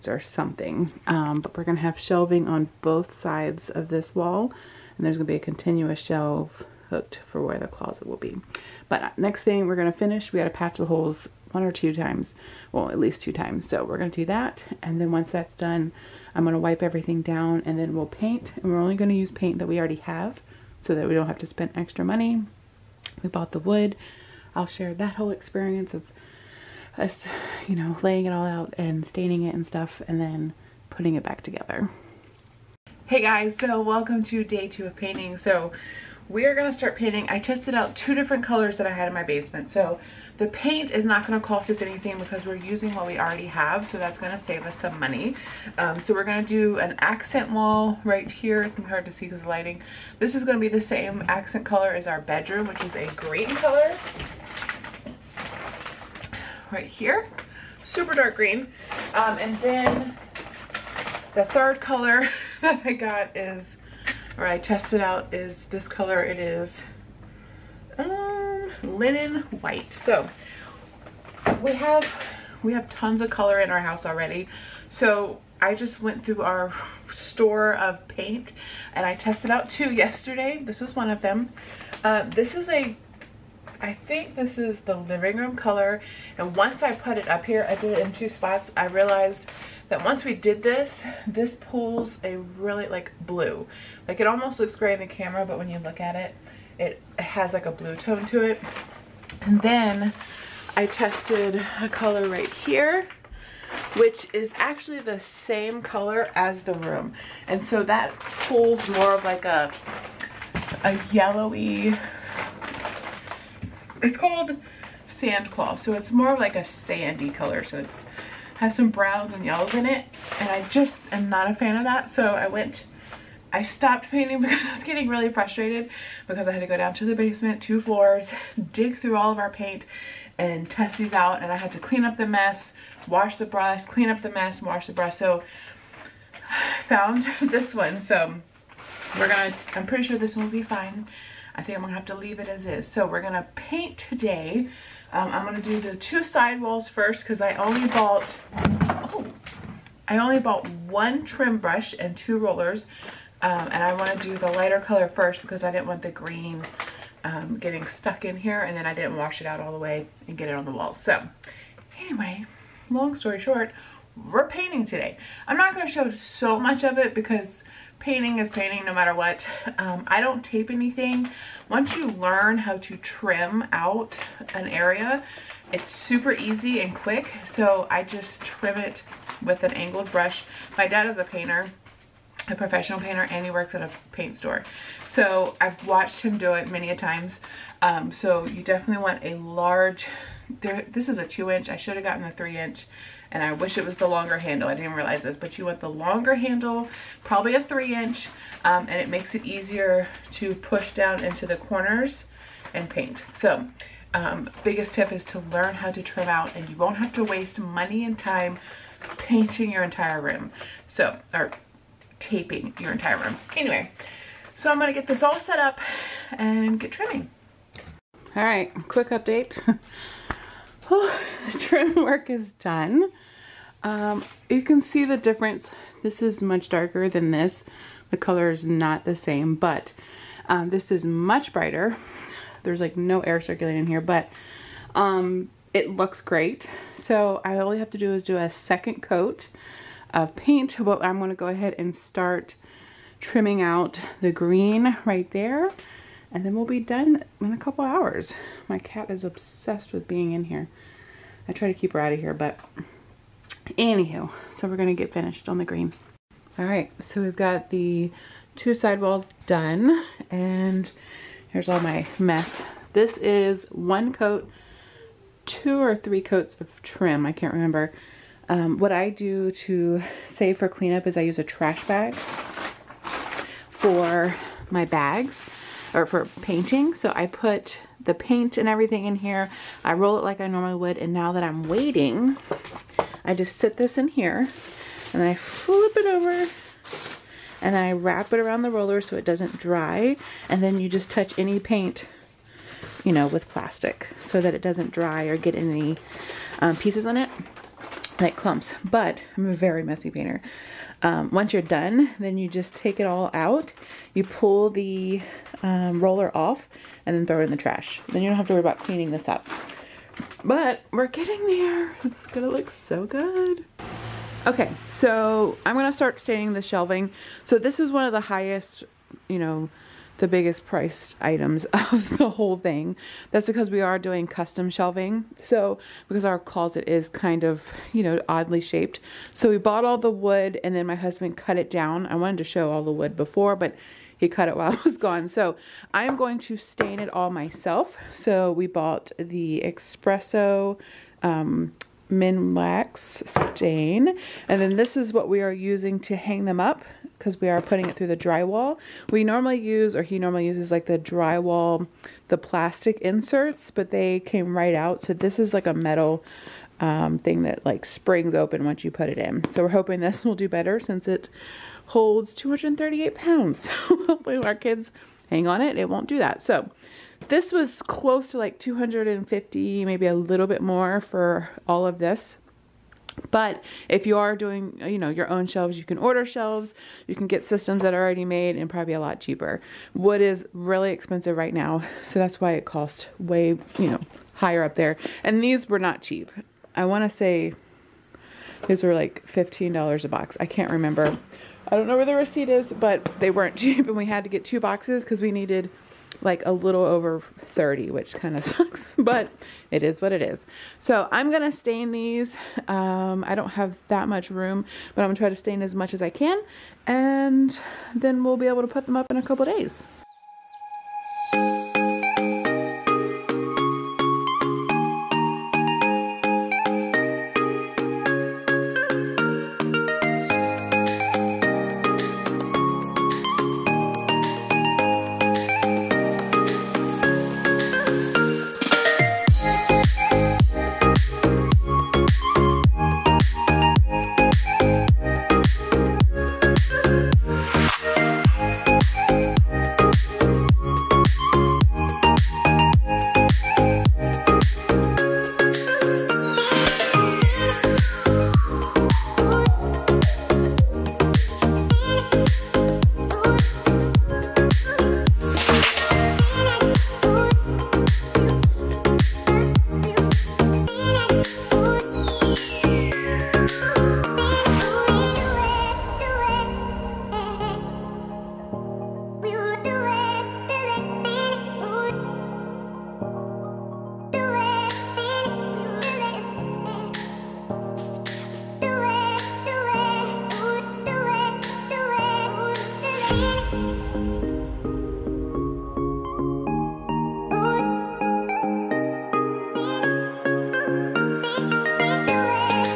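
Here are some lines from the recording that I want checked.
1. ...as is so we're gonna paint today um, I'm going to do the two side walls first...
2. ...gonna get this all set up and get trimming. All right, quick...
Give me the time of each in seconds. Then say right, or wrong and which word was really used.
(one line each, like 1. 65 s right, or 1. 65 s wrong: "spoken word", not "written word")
1. 142 s right
2. 214 s right.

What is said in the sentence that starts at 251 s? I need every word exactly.
I try to keep her out of here, but Anywho, so we're gonna get finished on the green.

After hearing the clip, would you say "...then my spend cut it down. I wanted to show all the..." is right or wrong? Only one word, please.
wrong.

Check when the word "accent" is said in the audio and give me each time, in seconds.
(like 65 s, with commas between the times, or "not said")
46 s, 51 s.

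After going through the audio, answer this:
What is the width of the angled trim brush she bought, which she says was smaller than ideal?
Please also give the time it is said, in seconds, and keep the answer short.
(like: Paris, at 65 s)
2 inch, at 191 s.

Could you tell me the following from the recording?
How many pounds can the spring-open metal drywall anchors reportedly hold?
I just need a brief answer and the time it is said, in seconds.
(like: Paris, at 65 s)
238, at 362 s.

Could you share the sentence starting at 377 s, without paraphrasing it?
You can get systems that are already made and probably a lot cheaper.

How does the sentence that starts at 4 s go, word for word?
And there's going to be a continuous shelf hooked for where the closet will be.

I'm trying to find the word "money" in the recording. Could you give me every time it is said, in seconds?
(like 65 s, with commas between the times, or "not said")
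22 s, 44 s, 207 s.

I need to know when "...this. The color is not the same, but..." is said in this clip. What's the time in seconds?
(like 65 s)
227 s.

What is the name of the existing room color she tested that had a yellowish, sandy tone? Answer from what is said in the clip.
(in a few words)
Sand claw.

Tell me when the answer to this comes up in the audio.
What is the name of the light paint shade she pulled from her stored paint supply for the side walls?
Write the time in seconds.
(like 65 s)
68 s.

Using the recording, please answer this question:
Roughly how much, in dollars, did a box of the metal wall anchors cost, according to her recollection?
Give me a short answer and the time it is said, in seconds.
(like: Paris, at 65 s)
$15, at 389 s.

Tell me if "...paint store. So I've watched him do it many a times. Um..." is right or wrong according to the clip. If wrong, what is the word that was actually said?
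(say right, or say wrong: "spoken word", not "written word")
right.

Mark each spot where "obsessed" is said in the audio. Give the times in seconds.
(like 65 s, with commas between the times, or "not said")
249 s.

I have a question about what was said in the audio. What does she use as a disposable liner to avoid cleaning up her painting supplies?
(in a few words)
Trash bag.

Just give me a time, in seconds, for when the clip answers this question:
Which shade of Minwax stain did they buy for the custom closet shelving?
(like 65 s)
339 s.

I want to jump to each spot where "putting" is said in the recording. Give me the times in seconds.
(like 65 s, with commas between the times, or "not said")
30 s, 347 s.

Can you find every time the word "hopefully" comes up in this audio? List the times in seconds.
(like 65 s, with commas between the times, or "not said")
363 s.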